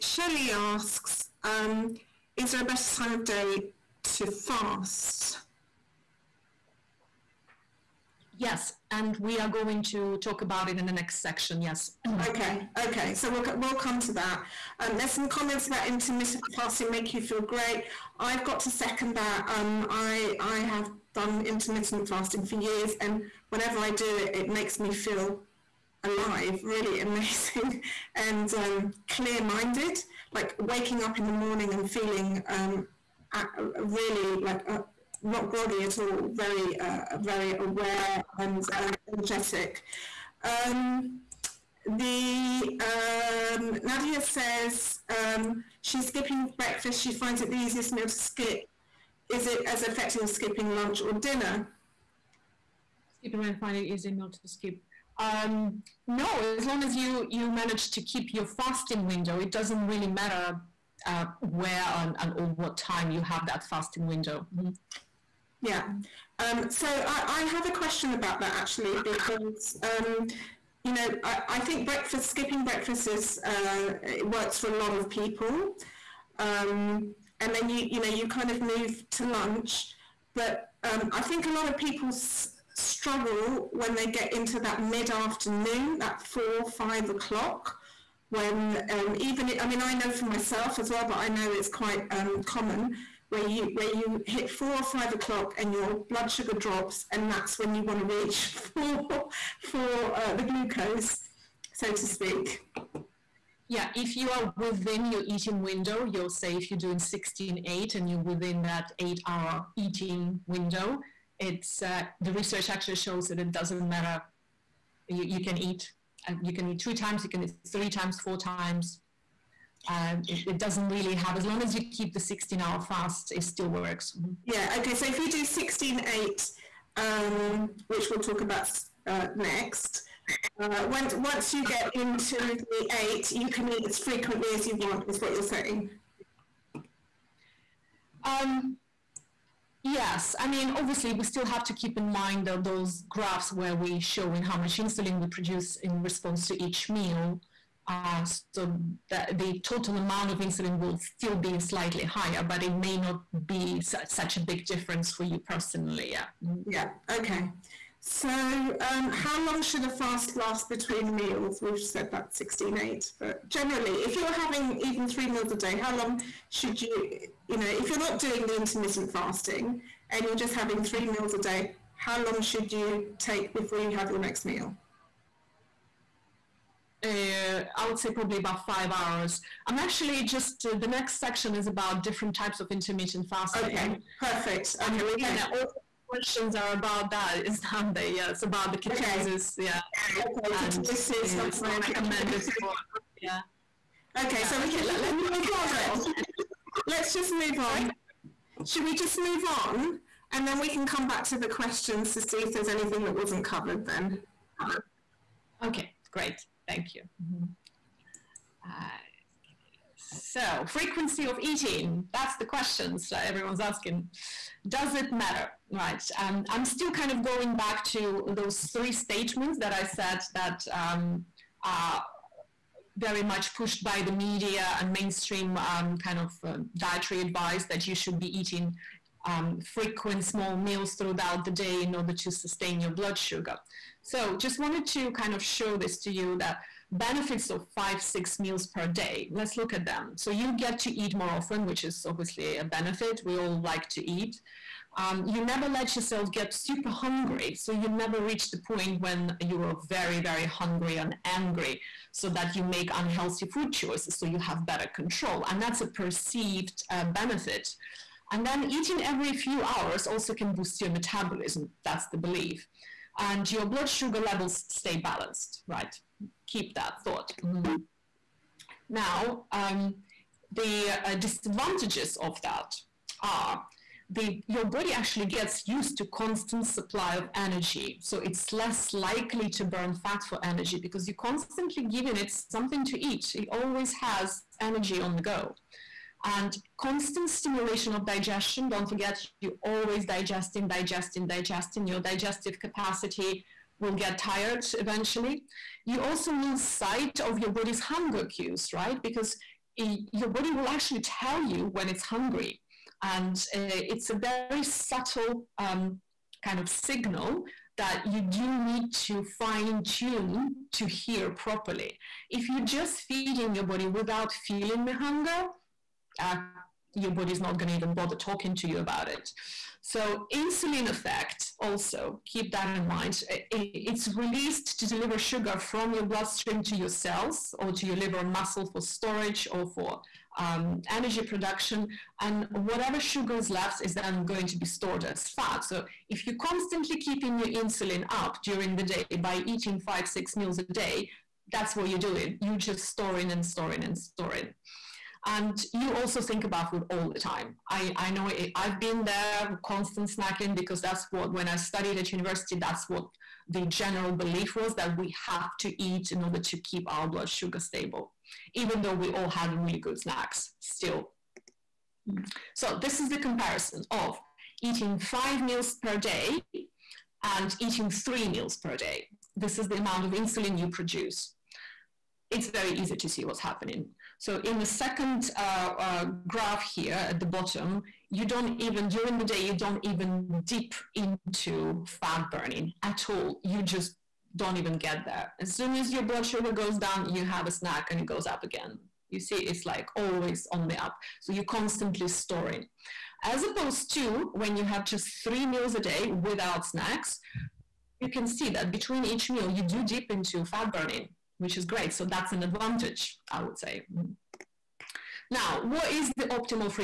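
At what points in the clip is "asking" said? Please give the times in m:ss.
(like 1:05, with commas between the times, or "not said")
3:33.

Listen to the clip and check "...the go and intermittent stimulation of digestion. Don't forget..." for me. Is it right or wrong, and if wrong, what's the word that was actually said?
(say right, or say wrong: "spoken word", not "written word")
wrong: "constant", not "intermittent".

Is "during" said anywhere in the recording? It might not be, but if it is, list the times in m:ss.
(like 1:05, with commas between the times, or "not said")
5:38, 6:18.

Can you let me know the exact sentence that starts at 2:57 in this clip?
uh, I would say probably about five hours.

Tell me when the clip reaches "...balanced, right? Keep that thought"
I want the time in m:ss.
4:24.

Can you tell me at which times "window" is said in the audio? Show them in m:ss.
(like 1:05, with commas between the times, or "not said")
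0:59, 1:04, 1:45, 1:50.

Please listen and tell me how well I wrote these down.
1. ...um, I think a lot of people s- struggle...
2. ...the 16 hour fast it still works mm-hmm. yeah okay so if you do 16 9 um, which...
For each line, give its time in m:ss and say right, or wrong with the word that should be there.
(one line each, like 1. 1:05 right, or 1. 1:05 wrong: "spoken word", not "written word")
1. 1:20 right
2. 2:02 wrong: "8", not "9".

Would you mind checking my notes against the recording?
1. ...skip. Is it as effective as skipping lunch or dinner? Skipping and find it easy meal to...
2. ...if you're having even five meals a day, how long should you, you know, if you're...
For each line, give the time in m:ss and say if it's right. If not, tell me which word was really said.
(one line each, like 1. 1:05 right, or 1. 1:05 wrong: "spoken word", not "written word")
1. 0:48 right
2. 2:44 wrong: "three", not "five".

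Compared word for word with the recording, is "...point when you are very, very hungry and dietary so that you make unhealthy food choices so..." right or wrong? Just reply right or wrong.
wrong.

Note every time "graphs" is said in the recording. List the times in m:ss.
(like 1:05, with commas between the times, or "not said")
2:23, 6:16.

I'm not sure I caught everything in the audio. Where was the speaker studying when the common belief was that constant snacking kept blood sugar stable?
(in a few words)
University.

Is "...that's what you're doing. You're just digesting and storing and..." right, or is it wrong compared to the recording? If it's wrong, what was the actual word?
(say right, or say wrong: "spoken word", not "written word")
wrong: "storing", not "digesting".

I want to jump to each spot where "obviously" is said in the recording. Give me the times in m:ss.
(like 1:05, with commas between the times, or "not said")
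2:20, 4:02.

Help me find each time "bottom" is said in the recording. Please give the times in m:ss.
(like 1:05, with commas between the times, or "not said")
6:17.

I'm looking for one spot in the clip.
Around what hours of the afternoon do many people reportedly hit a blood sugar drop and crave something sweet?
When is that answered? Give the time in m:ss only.
1:34.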